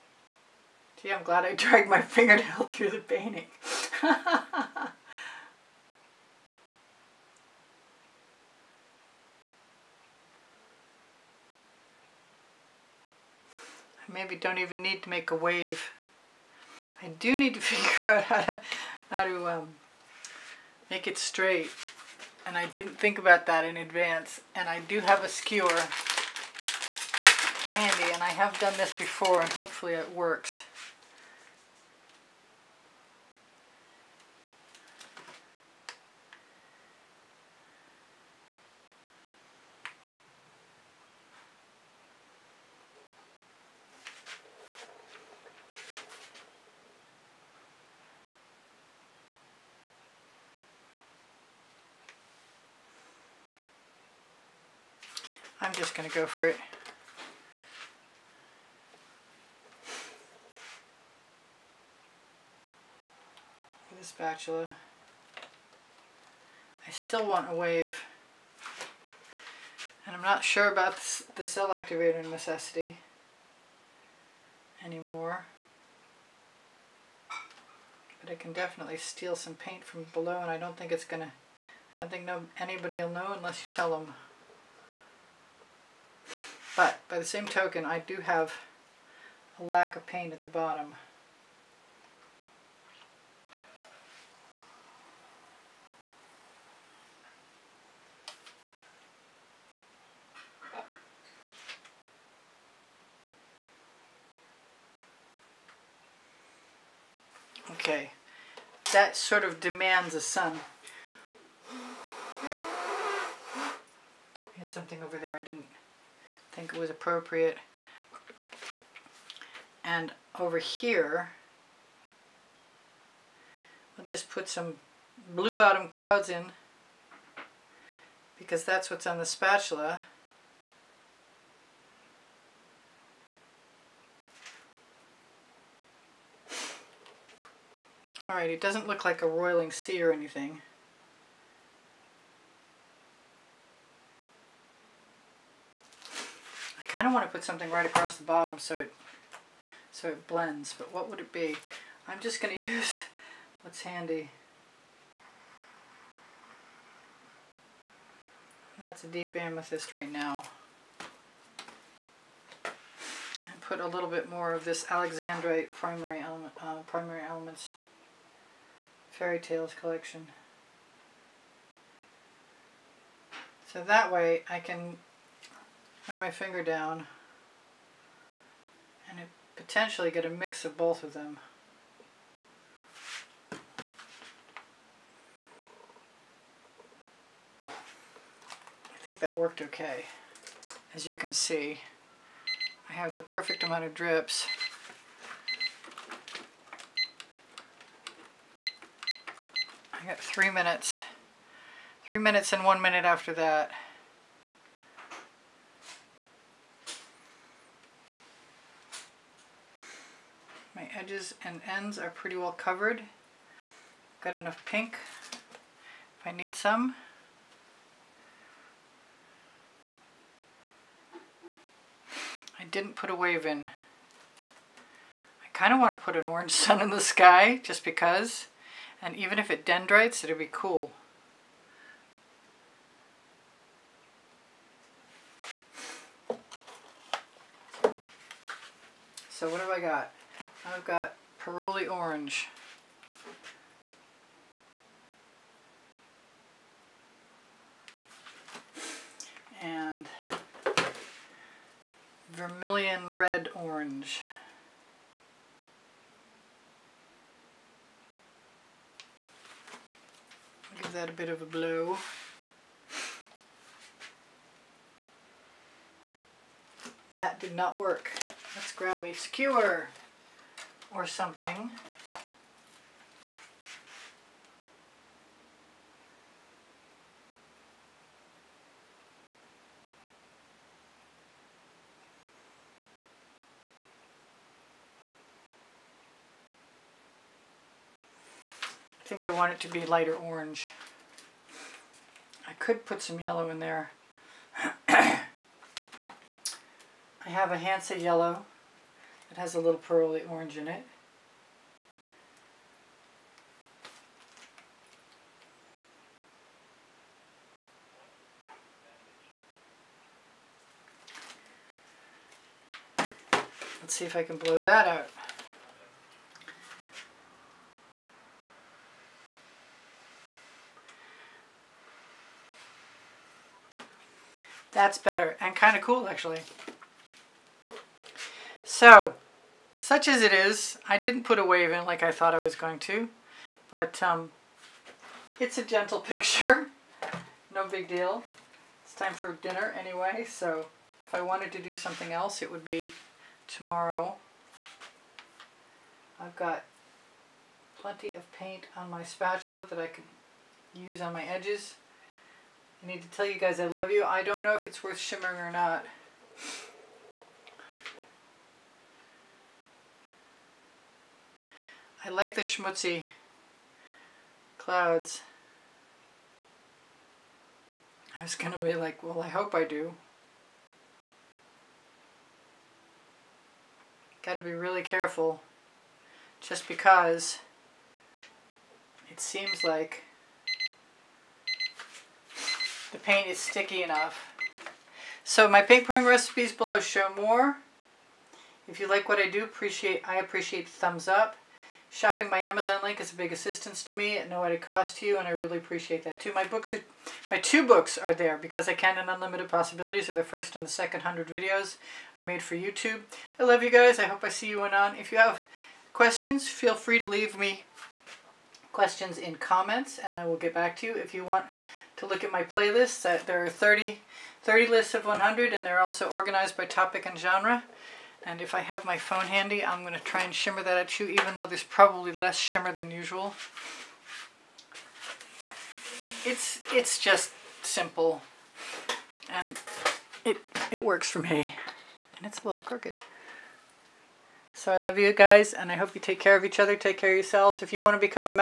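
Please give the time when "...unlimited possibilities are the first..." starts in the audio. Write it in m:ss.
6:39.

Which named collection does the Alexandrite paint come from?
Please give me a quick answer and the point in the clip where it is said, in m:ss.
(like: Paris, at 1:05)
Fairy tales collection, at 2:49.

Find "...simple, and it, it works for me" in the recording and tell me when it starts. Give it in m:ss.
7:07.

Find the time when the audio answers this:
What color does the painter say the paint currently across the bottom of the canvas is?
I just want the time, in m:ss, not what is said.
2:39.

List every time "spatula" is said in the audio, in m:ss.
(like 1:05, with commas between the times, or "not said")
1:04, 2:09, 5:49.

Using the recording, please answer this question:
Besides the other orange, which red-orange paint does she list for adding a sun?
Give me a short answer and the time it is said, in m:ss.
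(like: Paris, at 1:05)
Vermilion Red Orange, at 4:12.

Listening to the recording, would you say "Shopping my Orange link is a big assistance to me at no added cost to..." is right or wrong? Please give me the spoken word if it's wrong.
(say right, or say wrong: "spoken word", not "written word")
wrong: "Amazon", not "Orange".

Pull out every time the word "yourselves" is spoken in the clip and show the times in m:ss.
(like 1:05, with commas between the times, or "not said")
7:17.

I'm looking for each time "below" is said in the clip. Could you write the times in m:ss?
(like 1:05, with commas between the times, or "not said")
1:20, 6:26.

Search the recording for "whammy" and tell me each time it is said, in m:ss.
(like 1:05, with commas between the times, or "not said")
not said.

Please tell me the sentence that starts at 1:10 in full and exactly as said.
And I'm not sure about the cell activator necessity anymore.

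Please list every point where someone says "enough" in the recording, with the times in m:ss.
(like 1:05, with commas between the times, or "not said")
3:34, 6:23.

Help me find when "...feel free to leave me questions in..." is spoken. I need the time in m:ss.
6:46.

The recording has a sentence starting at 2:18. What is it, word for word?
Alright, it doesn't look like a roiling sea or anything.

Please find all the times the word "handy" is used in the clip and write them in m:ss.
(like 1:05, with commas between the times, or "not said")
0:27, 2:33, 6:59.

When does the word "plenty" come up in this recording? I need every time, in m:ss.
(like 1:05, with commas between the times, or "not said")
5:47.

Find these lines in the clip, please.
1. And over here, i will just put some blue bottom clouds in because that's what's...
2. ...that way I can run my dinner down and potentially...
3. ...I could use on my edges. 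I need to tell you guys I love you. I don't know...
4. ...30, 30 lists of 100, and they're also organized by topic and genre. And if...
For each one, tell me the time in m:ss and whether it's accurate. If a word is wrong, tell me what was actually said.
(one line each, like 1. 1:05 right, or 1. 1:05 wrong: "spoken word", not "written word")
1. 1:59 right
2. 2:53 wrong: "finger", not "dinner"
3. 5:49 right
4. 6:53 right.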